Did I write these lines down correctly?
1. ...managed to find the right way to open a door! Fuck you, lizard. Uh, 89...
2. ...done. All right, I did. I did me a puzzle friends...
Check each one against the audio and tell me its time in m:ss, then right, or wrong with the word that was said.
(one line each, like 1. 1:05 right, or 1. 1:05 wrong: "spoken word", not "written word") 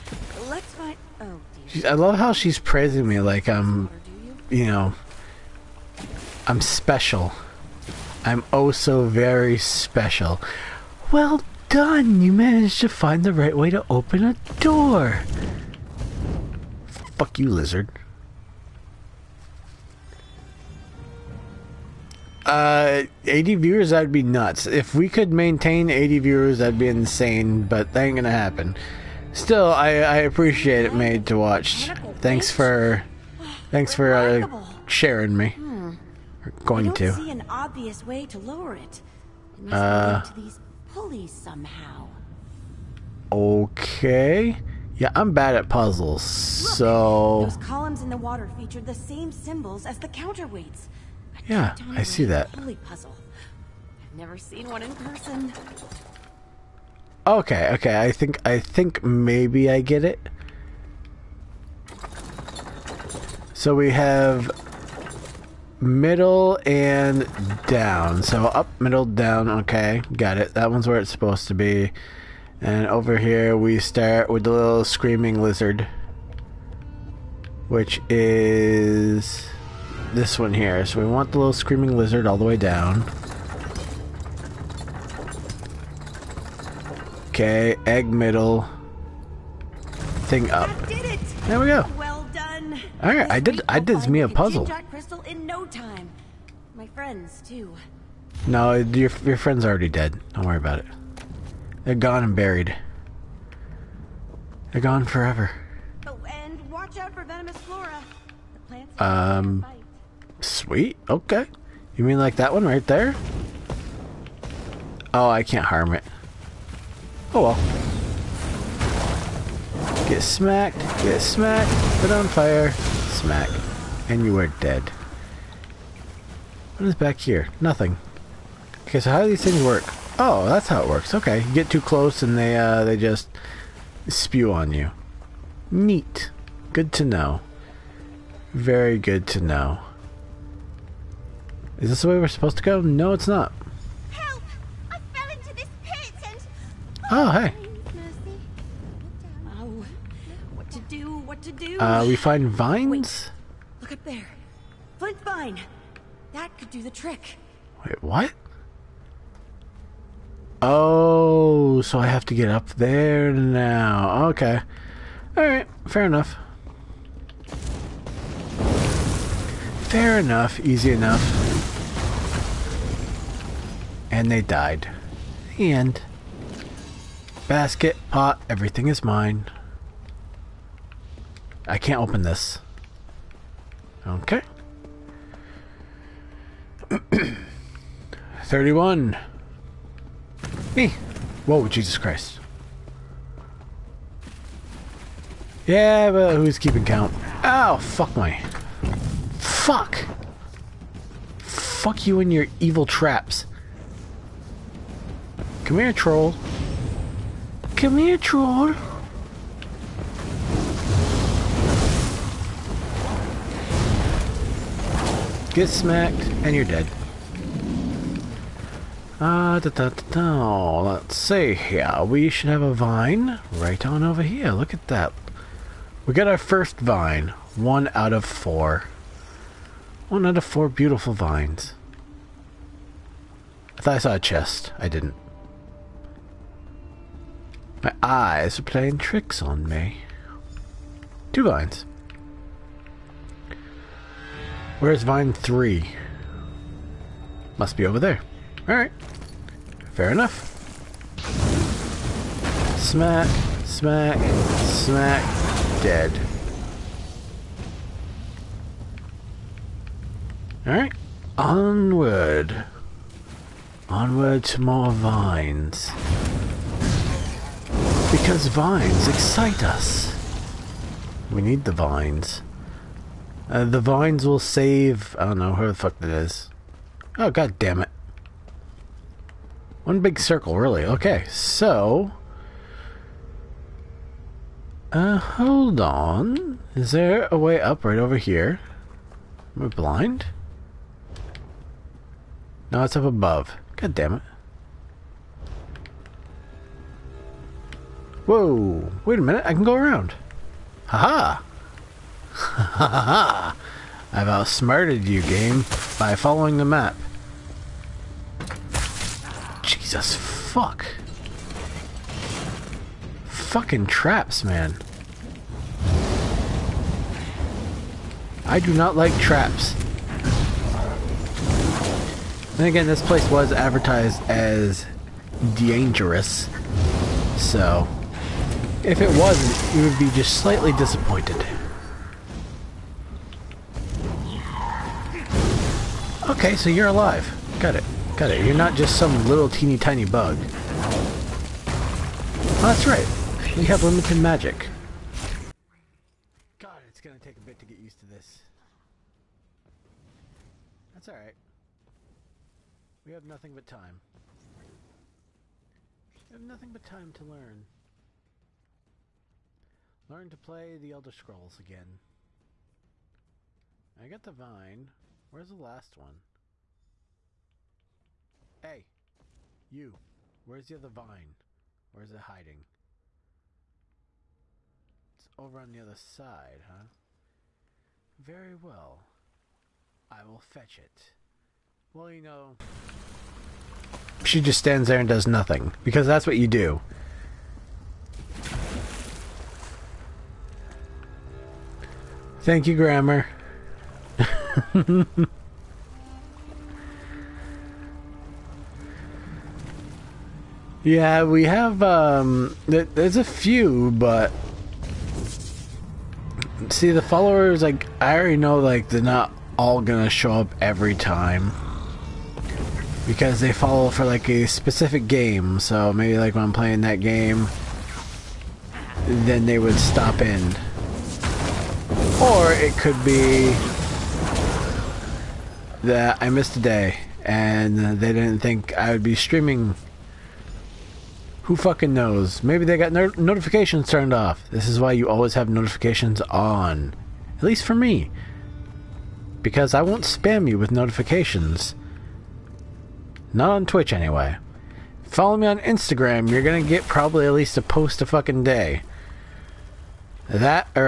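1. 0:12 wrong: "80", not "89"
2. 1:32 right.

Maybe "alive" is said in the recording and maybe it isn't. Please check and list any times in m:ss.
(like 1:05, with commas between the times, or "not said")
5:36.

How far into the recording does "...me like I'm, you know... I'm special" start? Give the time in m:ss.
0:03.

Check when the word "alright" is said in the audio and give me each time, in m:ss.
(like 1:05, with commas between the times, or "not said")
2:45, 4:08, 4:20, 5:51.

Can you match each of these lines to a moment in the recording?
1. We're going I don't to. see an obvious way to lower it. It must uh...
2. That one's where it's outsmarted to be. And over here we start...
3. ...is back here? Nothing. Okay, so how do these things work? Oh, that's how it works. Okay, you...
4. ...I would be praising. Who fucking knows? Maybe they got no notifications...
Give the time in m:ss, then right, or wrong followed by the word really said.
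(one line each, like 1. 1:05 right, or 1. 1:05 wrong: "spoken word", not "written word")
1. 0:36 right
2. 1:10 wrong: "supposed", not "outsmarted"
3. 2:06 right
4. 7:08 wrong: "streaming", not "praising".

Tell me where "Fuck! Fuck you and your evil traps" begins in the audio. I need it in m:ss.
3:19.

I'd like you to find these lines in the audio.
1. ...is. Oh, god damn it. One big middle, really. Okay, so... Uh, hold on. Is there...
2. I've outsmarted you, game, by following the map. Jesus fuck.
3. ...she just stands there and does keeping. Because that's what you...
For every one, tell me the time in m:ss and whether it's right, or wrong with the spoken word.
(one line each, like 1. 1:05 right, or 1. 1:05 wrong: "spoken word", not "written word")
1. 4:36 wrong: "circle", not "middle"
2. 5:04 right
3. 6:24 wrong: "nothing", not "keeping".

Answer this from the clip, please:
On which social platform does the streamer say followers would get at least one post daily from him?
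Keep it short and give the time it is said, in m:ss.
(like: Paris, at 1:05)
Instagram, at 7:25.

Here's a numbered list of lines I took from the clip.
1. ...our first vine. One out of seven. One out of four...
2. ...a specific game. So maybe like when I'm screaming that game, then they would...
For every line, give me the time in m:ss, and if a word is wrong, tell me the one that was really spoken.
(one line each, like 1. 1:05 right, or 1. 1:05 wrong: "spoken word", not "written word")
1. 3:46 wrong: "four", not "seven"
2. 6:54 wrong: "playing", not "screaming".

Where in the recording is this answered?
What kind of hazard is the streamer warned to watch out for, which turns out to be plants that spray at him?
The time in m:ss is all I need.
1:47.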